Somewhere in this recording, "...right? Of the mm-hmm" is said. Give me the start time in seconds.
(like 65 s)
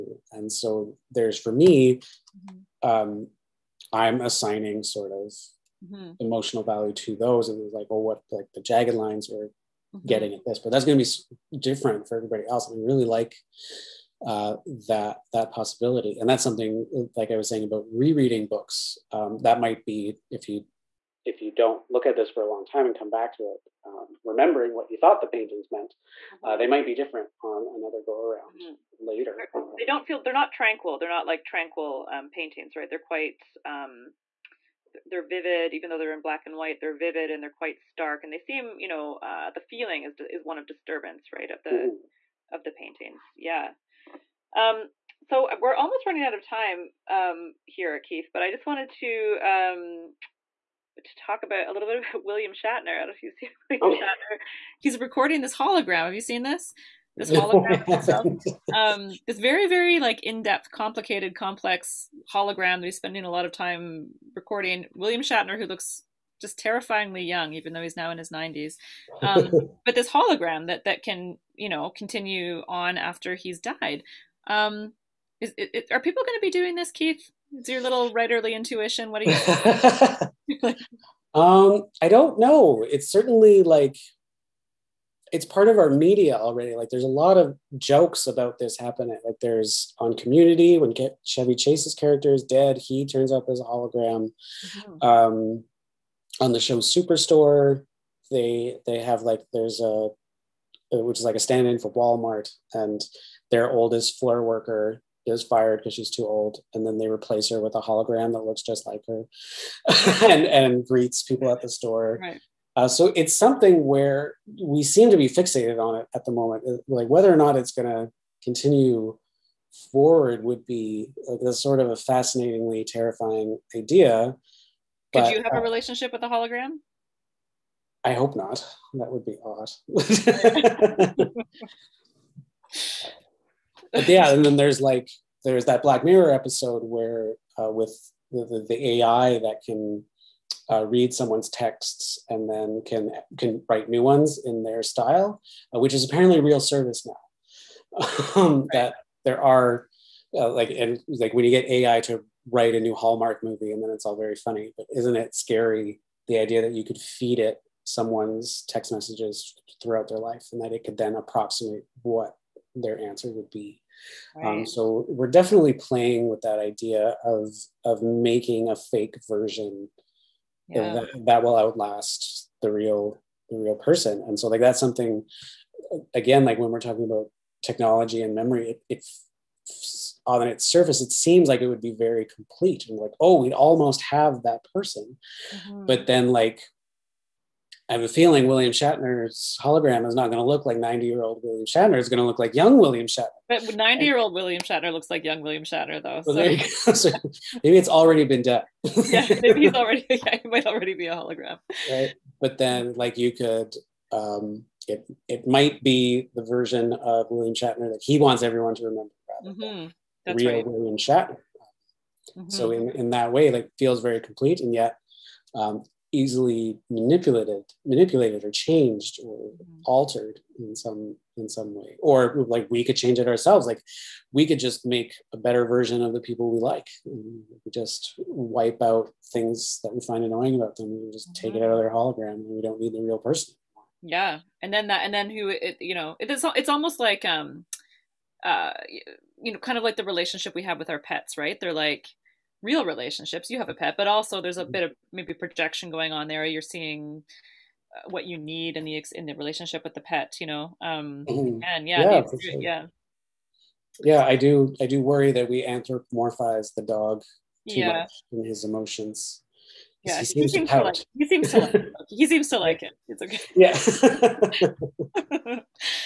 41 s.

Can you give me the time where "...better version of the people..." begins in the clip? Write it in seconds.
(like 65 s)
225 s.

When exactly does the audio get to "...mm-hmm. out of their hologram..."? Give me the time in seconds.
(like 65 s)
231 s.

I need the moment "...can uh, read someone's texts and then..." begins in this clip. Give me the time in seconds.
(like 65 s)
139 s.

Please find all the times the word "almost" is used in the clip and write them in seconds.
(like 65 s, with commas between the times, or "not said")
45 s, 183 s, 236 s.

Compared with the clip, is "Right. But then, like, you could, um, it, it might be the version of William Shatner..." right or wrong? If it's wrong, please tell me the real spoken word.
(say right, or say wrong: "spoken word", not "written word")
right.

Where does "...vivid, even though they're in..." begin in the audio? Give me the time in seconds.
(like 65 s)
35 s.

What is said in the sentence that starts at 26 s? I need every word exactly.
uh, they might be different on another go around mm-hmm.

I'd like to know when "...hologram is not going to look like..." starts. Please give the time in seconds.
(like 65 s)
189 s.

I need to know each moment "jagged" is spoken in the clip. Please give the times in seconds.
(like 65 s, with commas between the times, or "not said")
8 s.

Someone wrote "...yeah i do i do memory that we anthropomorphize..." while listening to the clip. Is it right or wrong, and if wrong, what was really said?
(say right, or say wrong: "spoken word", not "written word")
wrong: "worry", not "memory".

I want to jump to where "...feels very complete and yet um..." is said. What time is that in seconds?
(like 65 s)
213 s.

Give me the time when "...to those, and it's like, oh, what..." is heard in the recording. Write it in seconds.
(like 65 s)
6 s.